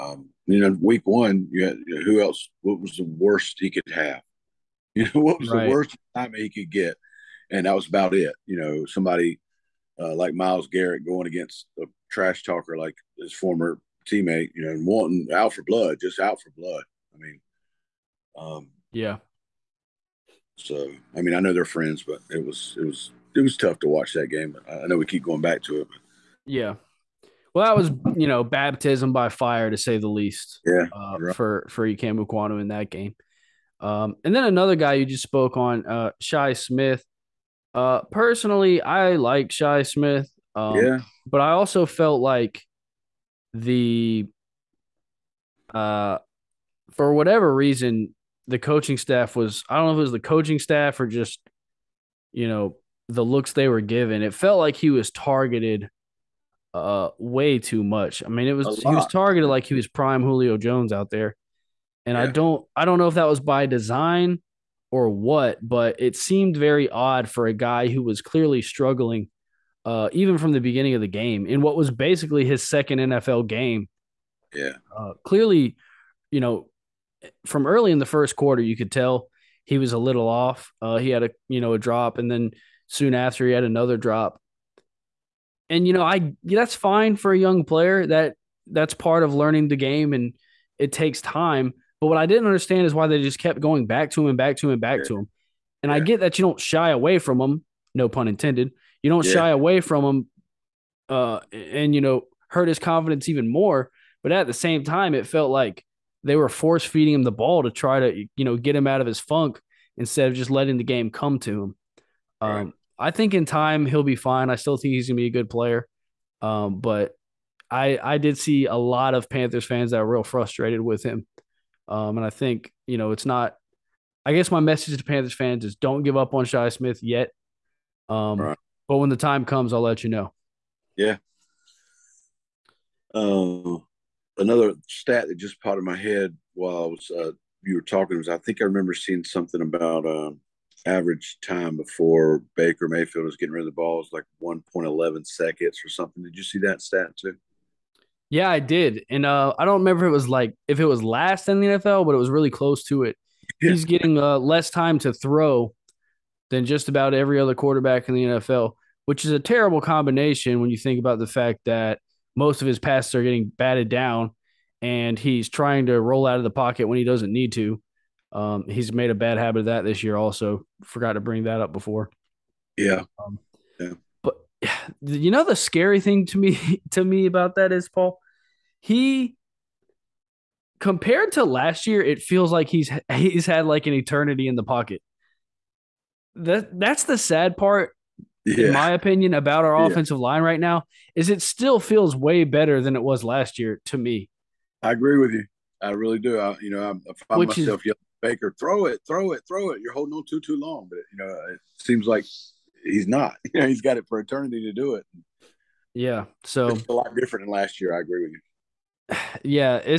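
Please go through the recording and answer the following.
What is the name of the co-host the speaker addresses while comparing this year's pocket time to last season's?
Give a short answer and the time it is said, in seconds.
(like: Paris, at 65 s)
Paul, at 177 s.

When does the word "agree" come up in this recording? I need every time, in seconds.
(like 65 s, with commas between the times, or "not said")
194 s, 208 s.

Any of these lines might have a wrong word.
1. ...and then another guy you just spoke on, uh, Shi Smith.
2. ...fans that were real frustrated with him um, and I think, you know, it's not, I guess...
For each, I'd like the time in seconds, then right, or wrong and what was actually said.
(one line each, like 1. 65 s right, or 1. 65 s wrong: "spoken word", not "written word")
1. 34 s right
2. 119 s right.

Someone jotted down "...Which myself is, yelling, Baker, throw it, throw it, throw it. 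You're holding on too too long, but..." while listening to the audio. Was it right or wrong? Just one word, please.
right.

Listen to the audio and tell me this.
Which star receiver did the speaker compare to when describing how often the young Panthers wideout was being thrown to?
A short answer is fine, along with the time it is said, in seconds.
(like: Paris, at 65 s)
Julio Jones, at 60 s.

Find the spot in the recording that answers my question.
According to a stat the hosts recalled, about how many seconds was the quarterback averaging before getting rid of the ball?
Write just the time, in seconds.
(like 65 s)
144 s.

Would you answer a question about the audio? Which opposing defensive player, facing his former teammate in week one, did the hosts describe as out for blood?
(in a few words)
Myles Garrett.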